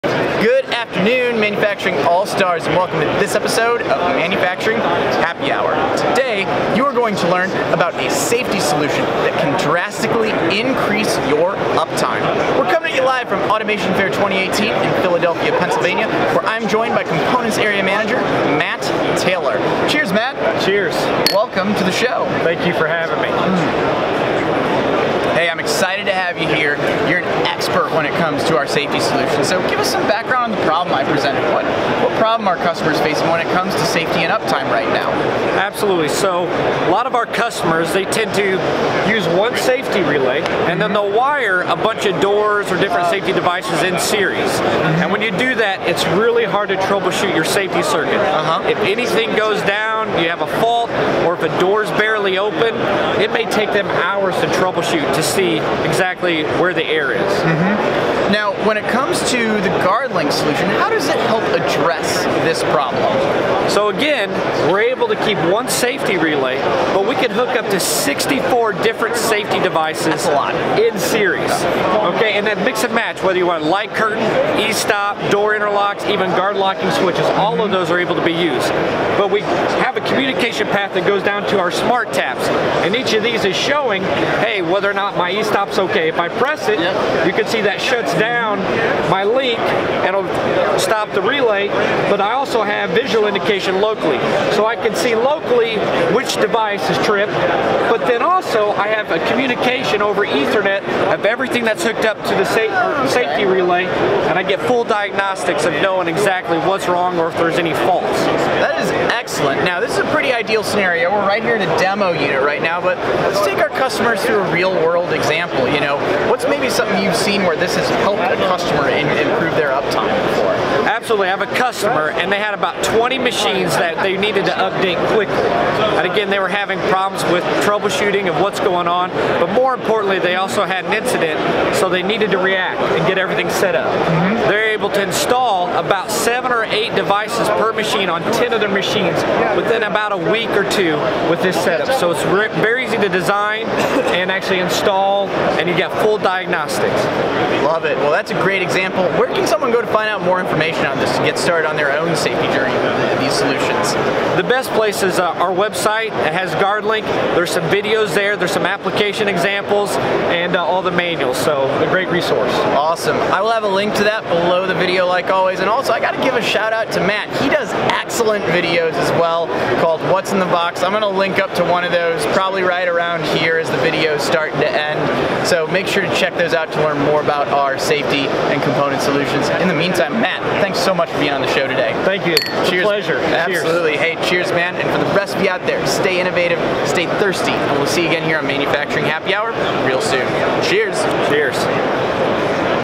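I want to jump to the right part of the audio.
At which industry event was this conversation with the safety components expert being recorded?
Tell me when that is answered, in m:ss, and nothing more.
0:13.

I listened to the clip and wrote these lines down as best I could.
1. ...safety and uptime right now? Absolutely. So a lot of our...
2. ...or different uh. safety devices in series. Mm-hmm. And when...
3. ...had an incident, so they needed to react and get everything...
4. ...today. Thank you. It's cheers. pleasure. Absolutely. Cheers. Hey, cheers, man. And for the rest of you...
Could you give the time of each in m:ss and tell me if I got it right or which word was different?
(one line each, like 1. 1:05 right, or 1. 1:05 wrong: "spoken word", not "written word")
1. 0:33 right
2. 0:42 right
3. 2:10 right
4. 3:01 right.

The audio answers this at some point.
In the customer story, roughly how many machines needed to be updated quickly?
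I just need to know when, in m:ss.
2:02.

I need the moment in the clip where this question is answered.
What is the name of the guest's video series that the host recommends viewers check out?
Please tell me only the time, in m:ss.
2:50.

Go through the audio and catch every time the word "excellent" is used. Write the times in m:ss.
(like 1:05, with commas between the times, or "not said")
1:49, 2:47.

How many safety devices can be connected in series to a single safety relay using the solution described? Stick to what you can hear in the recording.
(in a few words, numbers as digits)
64.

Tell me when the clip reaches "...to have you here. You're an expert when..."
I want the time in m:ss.
0:26.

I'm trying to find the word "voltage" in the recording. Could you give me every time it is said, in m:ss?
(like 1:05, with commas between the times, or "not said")
not said.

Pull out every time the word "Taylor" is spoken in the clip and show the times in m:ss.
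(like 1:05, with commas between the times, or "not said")
0:19.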